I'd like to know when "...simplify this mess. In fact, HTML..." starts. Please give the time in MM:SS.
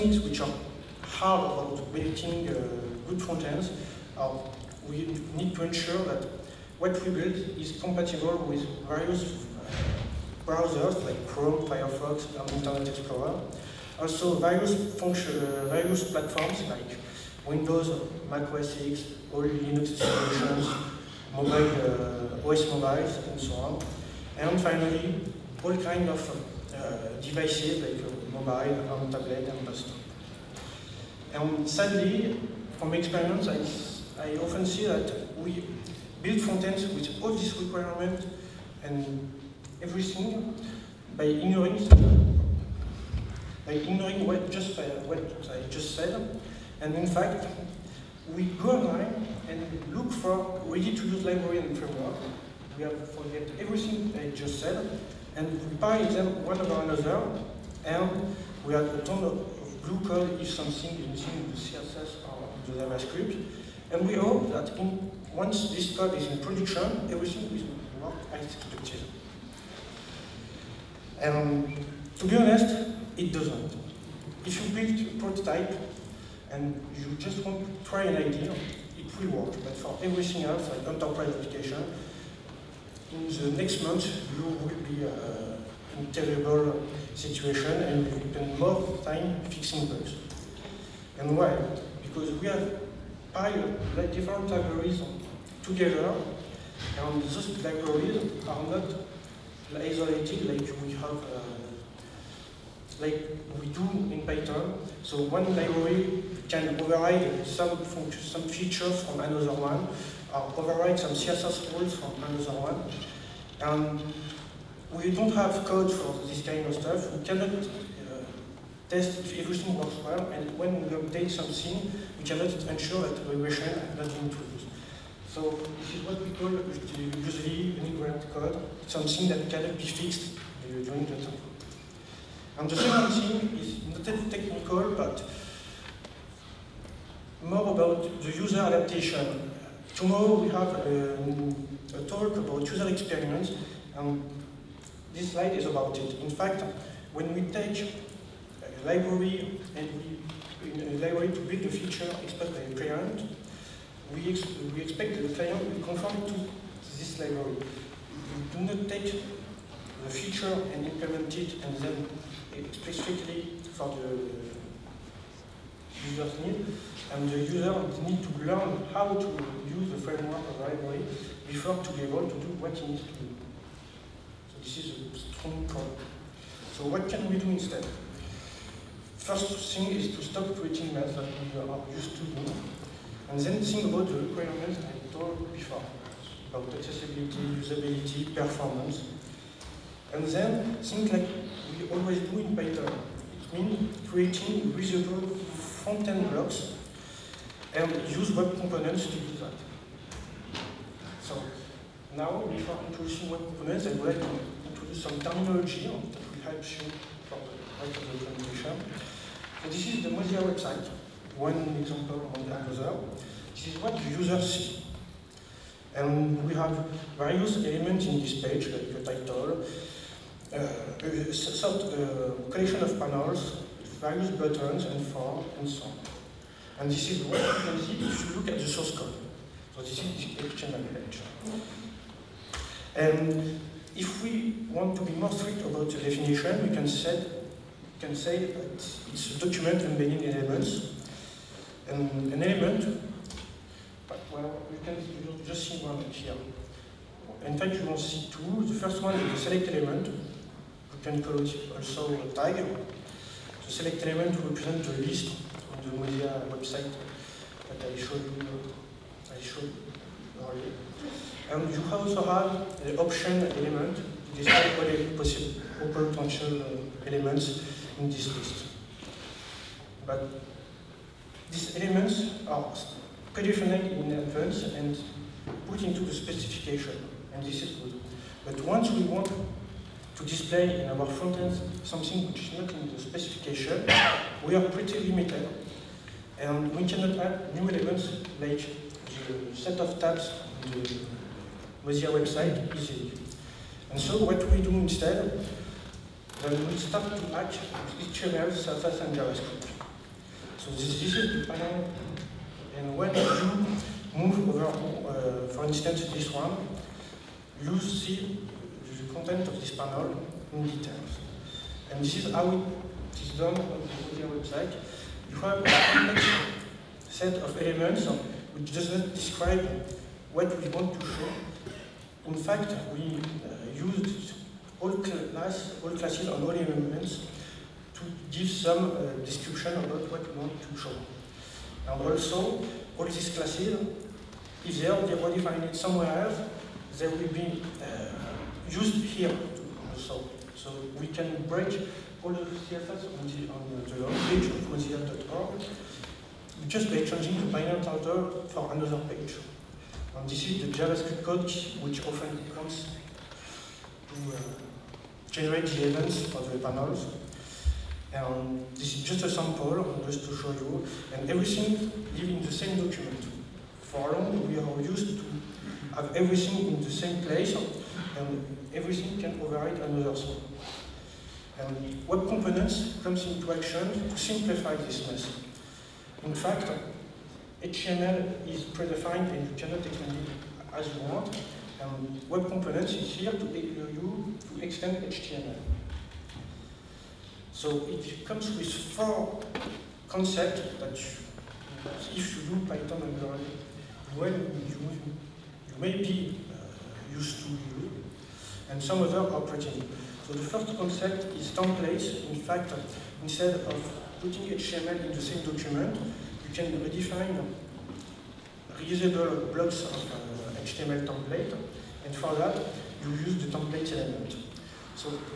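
06:14.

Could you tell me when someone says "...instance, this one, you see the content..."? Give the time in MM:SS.
05:05.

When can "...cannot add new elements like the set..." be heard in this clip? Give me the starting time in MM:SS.
04:46.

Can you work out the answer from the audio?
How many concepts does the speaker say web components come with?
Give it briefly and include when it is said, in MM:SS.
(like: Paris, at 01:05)
4, at 06:28.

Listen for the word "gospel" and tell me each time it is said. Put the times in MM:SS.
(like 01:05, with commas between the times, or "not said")
not said.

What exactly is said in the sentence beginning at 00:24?
And finally, all kind of uh, devices like uh, mobile or tablet and desktop.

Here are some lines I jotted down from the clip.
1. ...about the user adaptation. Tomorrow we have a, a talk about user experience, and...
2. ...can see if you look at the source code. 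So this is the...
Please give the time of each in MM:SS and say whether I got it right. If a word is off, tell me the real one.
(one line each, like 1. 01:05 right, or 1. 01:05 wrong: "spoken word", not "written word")
1. 02:17 right
2. 03:47 right.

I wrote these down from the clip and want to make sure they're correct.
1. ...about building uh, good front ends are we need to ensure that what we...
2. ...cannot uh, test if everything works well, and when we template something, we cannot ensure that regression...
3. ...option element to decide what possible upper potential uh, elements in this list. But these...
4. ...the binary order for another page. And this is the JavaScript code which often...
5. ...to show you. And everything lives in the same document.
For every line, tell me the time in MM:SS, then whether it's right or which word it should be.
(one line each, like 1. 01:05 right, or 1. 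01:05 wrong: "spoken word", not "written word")
1. 00:01 right
2. 01:57 wrong: "update", not "template"
3. 04:22 right
4. 05:47 right
5. 06:00 right.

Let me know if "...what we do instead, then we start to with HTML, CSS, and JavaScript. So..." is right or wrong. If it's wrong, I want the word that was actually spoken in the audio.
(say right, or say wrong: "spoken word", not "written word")
right.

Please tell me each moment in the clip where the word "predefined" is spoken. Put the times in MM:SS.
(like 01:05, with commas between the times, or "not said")
04:33, 06:18.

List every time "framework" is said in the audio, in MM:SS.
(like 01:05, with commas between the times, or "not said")
00:51, 02:49.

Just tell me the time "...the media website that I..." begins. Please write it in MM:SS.
04:15.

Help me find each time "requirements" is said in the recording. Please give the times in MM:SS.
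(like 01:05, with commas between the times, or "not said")
00:37, 03:04.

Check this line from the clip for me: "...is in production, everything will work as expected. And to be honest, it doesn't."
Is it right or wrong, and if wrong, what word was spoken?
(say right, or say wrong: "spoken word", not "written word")
right.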